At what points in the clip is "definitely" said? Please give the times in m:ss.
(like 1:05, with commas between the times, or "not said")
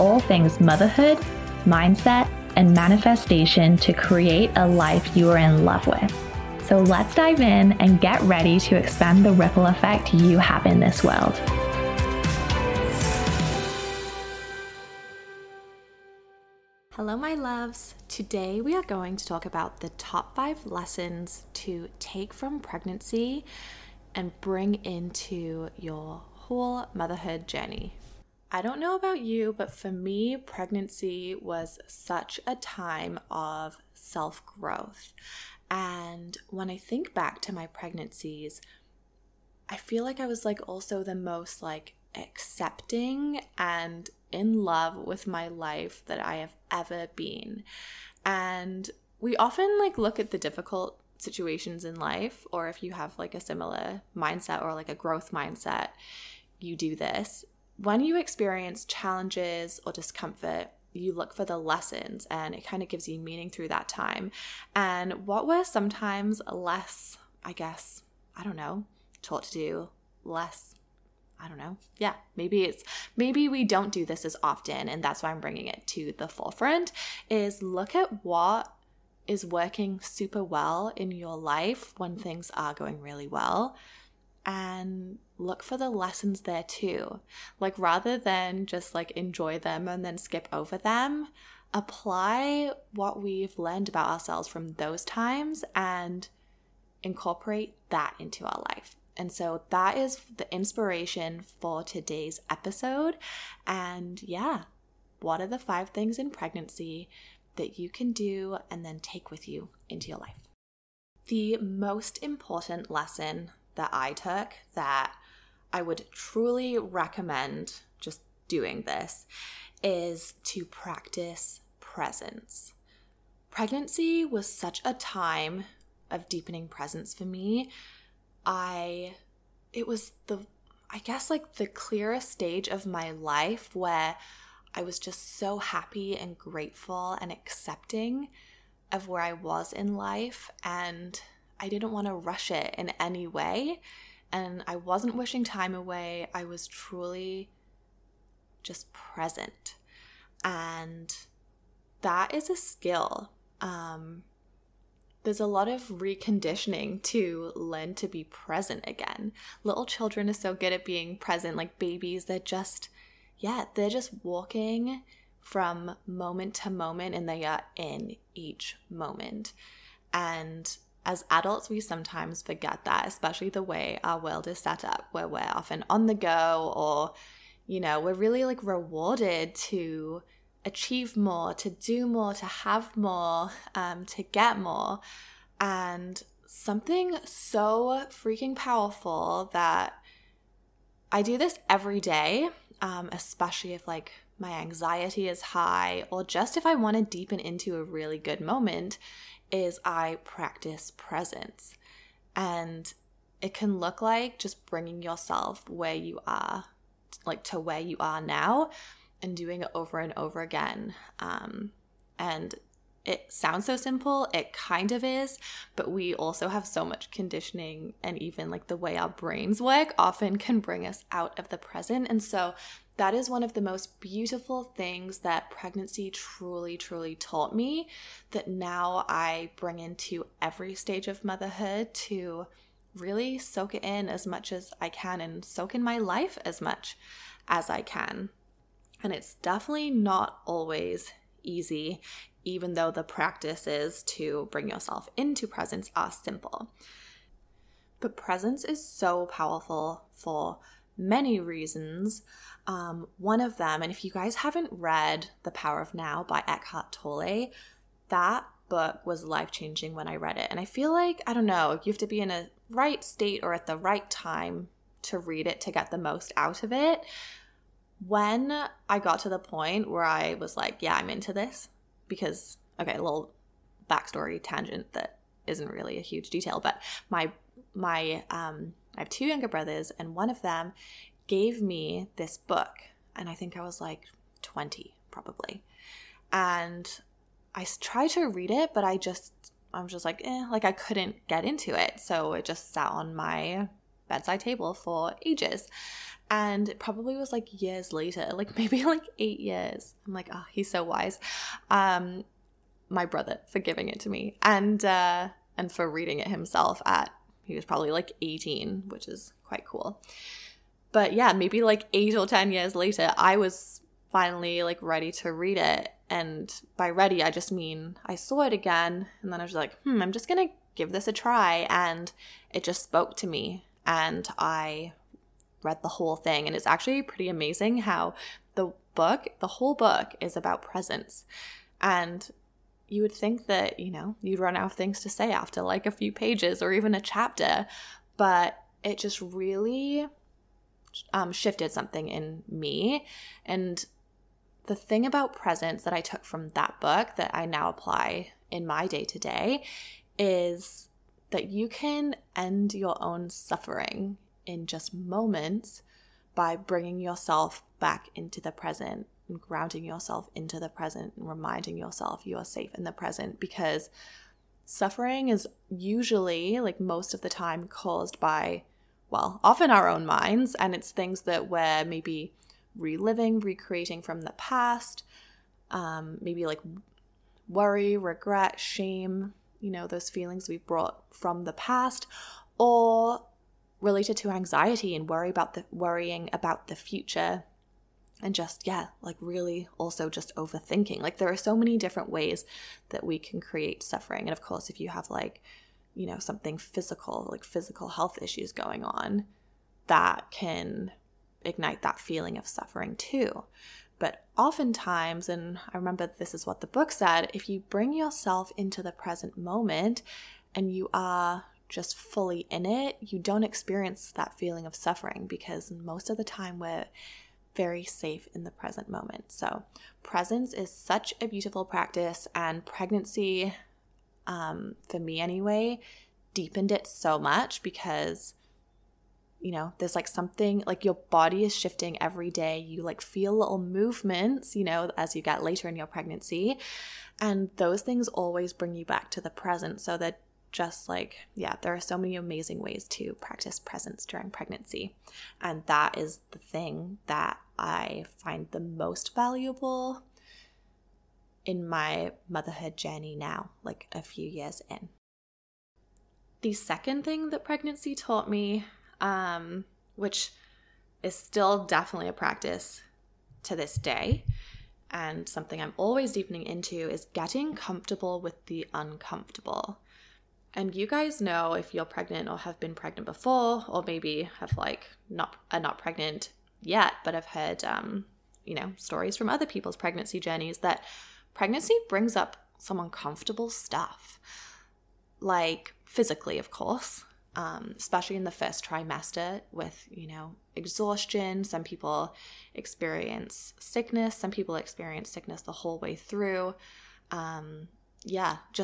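3:59, 7:41.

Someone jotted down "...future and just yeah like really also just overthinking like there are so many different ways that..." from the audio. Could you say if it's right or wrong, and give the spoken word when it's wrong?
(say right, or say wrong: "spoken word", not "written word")
right.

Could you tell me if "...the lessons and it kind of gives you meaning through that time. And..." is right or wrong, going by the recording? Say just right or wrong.
right.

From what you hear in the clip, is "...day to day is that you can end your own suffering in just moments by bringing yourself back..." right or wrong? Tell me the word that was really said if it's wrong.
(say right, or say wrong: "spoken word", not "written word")
right.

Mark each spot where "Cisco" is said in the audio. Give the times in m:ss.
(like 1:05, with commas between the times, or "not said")
not said.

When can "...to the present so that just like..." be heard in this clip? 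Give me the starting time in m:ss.
7:19.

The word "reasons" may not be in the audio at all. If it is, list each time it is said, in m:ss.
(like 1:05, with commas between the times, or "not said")
4:11.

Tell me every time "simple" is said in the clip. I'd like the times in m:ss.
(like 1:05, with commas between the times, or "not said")
3:33, 4:06.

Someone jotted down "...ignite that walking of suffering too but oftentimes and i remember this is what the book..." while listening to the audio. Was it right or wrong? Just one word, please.
wrong.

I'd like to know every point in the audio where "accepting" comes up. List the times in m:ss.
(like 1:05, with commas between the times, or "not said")
0:42, 2:17.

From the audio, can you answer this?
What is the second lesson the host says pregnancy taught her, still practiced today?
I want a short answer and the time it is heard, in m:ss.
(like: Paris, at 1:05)
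Getting comfortable with the uncomfortable, at 7:47.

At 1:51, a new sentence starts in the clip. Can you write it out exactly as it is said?
The most important lesson that I took that I would truly recommend just doing this is to practice presence.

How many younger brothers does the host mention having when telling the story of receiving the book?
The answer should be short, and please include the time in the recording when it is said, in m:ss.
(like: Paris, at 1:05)
2, at 4:39.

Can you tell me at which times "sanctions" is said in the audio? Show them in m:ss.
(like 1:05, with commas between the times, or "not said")
not said.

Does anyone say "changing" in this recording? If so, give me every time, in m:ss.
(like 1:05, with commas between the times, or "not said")
4:19.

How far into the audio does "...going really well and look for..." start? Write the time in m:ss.
1:22.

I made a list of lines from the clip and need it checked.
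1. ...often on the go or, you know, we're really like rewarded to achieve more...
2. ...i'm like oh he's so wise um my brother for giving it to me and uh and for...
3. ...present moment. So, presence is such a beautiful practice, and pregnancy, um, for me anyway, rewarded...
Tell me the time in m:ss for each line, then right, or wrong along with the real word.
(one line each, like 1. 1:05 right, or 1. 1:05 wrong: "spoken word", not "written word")
1. 2:55 right
2. 5:00 right
3. 6:58 wrong: "deepened", not "rewarded".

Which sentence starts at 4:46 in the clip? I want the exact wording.
And I tried to read it, but I just, I'm just like, eh, like I couldn't get into it.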